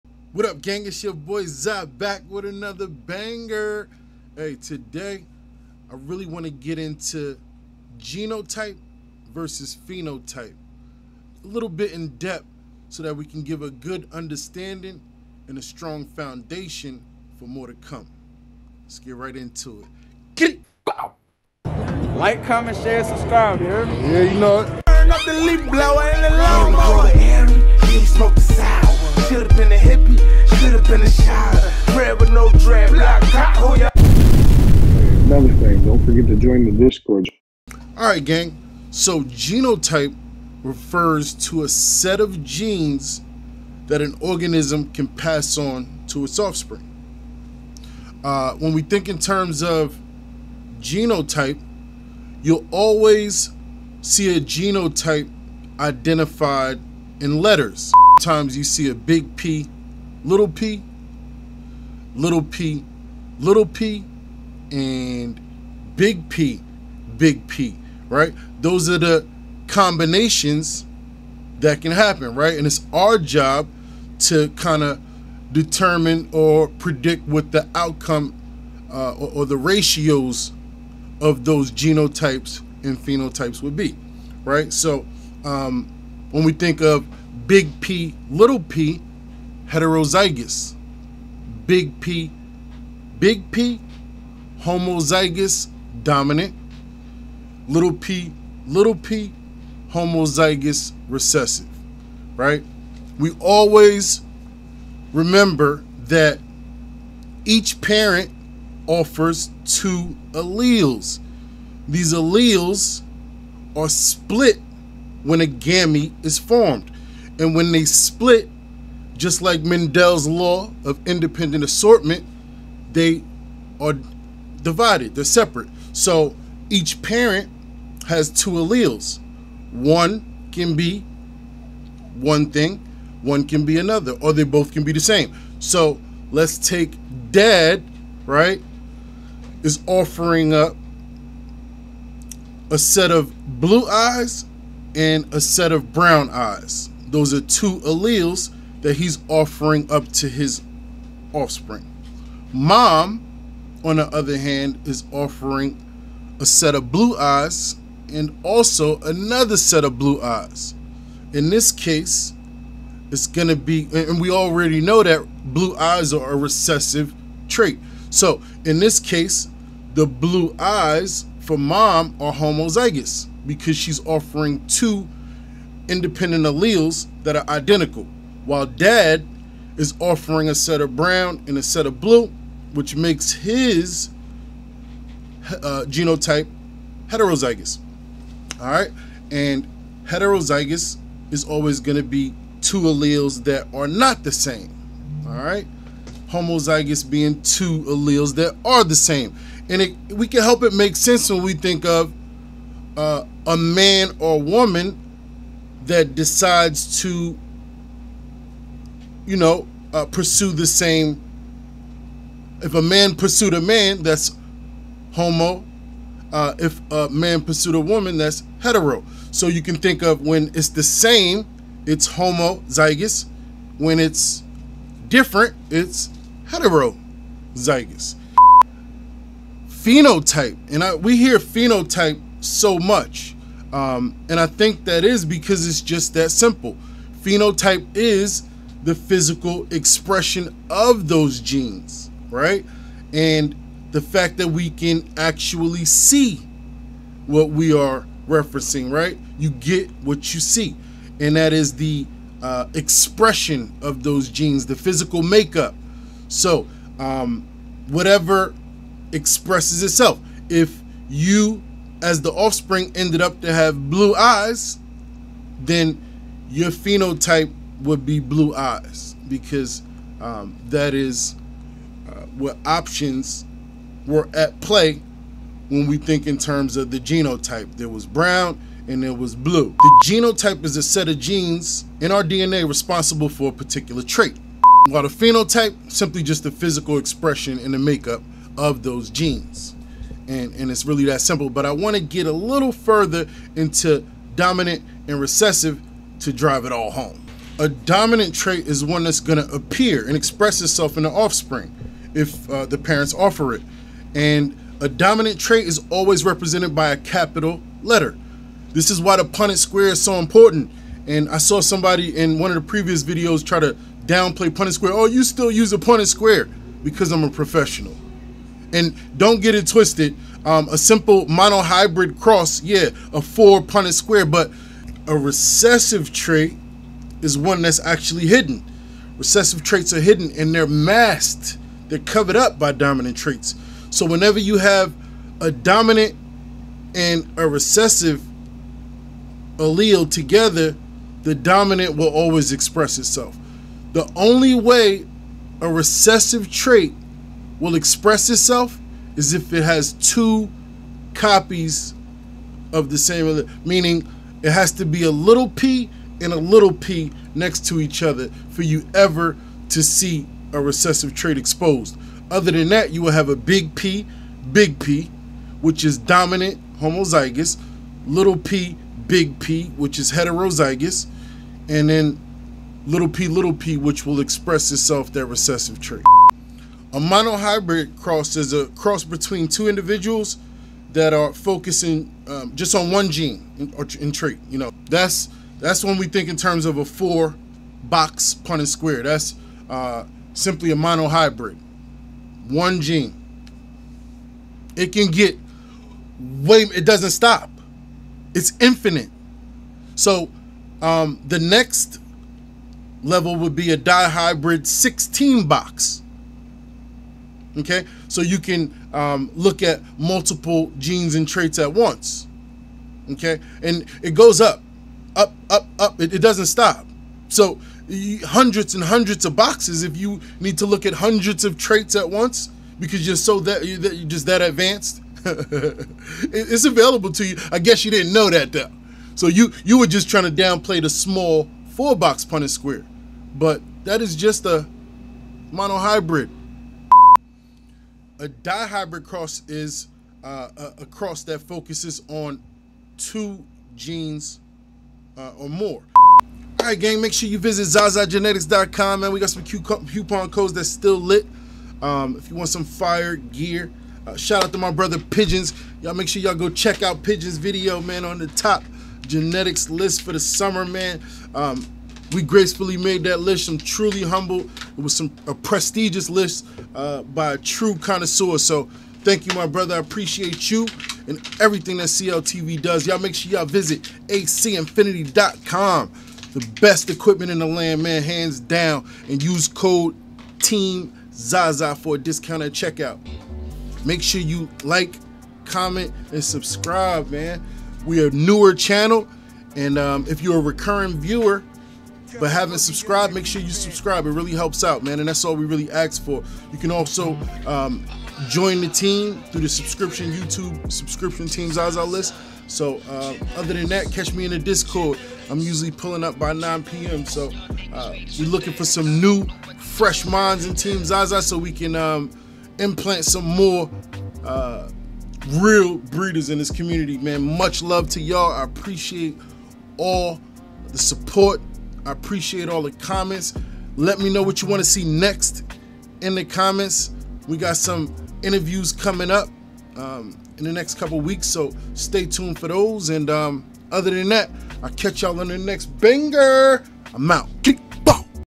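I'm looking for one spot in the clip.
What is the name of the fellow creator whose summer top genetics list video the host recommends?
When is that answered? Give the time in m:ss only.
7:37.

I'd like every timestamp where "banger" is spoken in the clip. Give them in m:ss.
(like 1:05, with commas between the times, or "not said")
0:02, 8:55.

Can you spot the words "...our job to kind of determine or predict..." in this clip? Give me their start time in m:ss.
1:12.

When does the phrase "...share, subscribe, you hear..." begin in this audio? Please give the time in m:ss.
0:22.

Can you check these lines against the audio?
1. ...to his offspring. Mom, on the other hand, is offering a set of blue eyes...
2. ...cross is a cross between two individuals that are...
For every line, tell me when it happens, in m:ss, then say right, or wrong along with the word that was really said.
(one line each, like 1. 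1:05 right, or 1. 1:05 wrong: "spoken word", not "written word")
1. 2:30 right
2. 6:18 right.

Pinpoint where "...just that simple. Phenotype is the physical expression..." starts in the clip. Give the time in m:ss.
3:55.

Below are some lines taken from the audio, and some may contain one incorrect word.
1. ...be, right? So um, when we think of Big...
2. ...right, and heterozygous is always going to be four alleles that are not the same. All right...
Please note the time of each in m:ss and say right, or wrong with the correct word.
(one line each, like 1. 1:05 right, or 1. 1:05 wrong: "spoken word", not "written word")
1. 1:23 right
2. 3:08 wrong: "two", not "four".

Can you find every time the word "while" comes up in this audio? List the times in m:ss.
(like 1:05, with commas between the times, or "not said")
2:58, 4:44.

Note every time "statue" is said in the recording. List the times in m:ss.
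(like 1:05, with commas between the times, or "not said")
not said.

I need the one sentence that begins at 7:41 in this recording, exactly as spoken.
Um, we gracefully made that list.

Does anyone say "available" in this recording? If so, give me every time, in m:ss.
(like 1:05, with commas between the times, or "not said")
7:06.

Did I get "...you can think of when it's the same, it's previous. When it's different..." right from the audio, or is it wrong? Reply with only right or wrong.
wrong.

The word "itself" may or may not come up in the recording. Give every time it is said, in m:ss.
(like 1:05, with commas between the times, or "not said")
4:19, 5:00, 5:42, 5:48, 6:14.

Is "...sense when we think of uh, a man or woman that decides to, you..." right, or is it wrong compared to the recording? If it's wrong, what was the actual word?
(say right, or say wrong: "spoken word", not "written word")
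right.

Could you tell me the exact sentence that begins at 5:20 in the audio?
Um, a simple monohybrid cross, yeah, a four Punnett square, but a recessive trait is one that's actually hidden.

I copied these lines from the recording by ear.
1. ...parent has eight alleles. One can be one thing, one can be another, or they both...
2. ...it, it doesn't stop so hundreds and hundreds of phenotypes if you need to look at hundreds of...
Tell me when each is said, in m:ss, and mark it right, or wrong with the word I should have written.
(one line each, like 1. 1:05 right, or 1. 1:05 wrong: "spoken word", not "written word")
1. 2:07 wrong: "two", not "eight"
2. 6:56 wrong: "boxes", not "phenotypes".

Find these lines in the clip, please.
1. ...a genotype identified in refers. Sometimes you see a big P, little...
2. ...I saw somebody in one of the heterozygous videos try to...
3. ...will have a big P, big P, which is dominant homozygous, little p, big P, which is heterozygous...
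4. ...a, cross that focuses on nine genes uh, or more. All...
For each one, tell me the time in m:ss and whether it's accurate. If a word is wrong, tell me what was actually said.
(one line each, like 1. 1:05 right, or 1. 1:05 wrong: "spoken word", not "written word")
1. 0:54 wrong: "letters", not "refers"
2. 5:11 wrong: "previous", not "heterozygous"
3. 6:03 right
4. 7:20 wrong: "two", not "nine".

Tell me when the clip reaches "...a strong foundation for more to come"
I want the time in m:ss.
0:15.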